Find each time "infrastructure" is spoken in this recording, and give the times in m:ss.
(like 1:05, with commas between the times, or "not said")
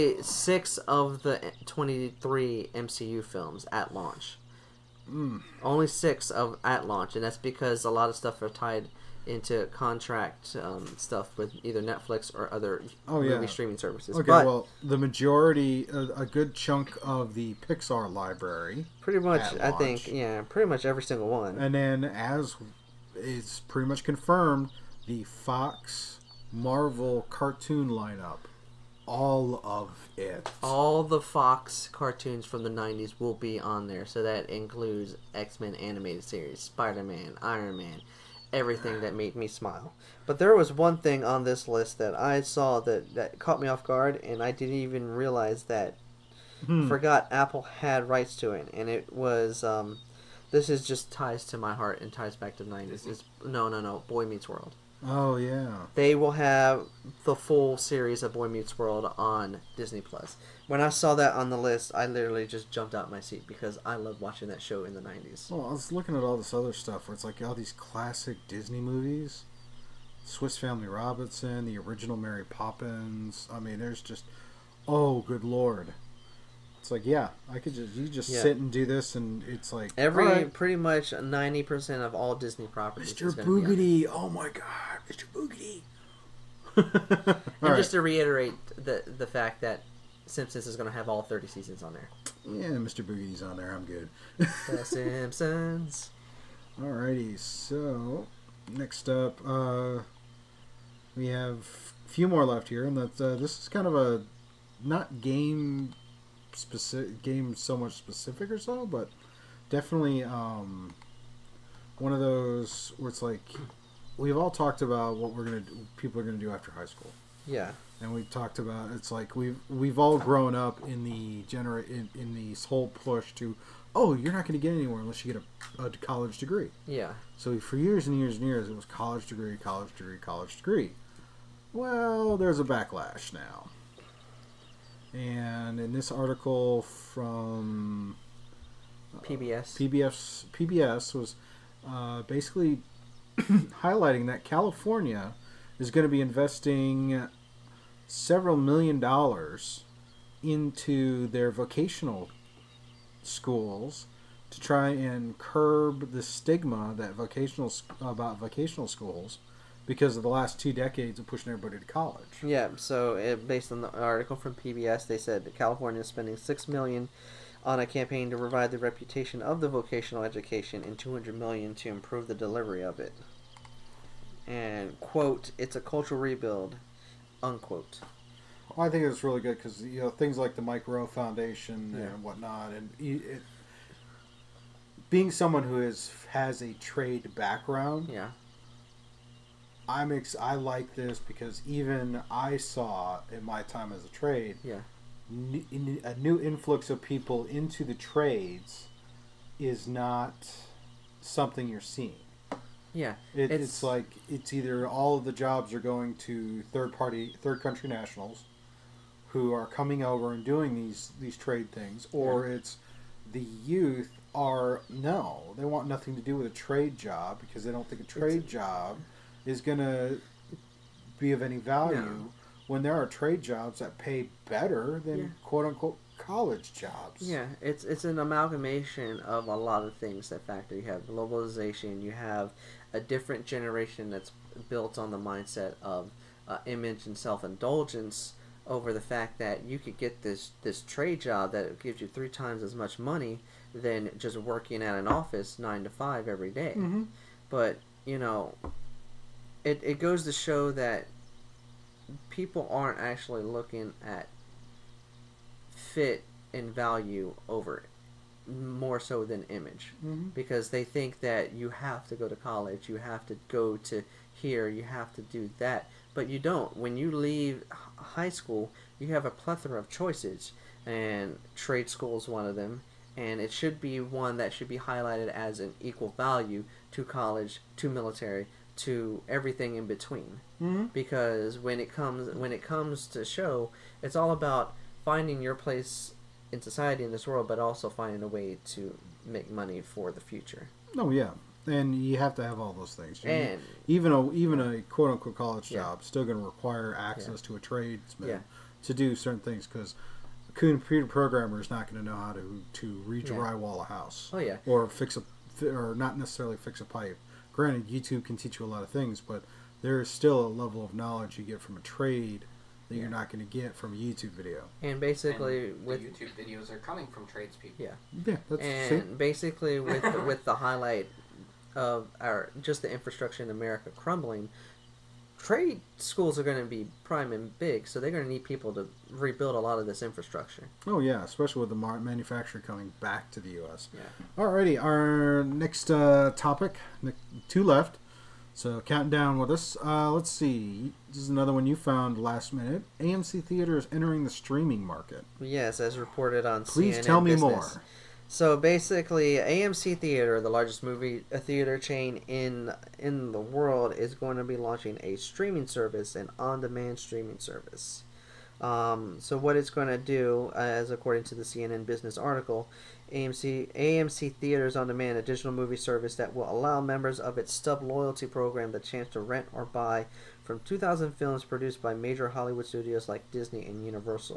5:22, 5:30.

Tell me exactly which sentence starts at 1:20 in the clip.
pretty much ninety percent of all Disney properties.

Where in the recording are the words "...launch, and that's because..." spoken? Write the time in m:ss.
0:06.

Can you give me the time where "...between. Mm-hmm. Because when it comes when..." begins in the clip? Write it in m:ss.
4:39.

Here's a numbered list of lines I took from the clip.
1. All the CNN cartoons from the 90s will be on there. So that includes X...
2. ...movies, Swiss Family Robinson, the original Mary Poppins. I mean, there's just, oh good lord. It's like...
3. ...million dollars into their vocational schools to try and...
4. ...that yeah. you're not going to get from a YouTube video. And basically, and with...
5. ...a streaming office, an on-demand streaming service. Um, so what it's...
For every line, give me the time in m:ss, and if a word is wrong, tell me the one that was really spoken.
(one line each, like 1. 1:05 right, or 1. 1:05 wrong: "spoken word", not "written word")
1. 0:30 wrong: "Fox", not "CNN"
2. 1:08 right
3. 2:28 right
4. 5:12 right
5. 5:55 wrong: "service", not "office".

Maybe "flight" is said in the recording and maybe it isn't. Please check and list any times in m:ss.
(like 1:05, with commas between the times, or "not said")
not said.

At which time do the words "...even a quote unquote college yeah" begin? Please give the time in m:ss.
4:54.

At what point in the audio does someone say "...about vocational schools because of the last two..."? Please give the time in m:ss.
2:38.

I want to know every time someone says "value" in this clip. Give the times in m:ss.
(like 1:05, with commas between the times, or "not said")
3:41, 4:16, 4:36.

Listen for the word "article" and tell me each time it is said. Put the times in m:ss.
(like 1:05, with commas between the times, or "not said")
2:16, 2:43, 6:02.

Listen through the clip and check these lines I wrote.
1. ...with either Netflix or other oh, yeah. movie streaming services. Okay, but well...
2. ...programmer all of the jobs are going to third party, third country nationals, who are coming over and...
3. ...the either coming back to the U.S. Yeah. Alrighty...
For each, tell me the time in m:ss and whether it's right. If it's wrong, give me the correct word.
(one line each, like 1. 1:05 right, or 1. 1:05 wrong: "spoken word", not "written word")
1. 0:11 right
2. 3:24 wrong: "either", not "programmer"
3. 5:31 wrong: "manufacturer", not "either".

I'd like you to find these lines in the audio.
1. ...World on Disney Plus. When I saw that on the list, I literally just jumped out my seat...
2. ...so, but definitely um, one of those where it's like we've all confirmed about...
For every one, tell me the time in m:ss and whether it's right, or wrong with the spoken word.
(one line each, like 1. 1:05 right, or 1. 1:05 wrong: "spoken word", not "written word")
1. 0:58 right
2. 1:48 wrong: "talked", not "confirmed".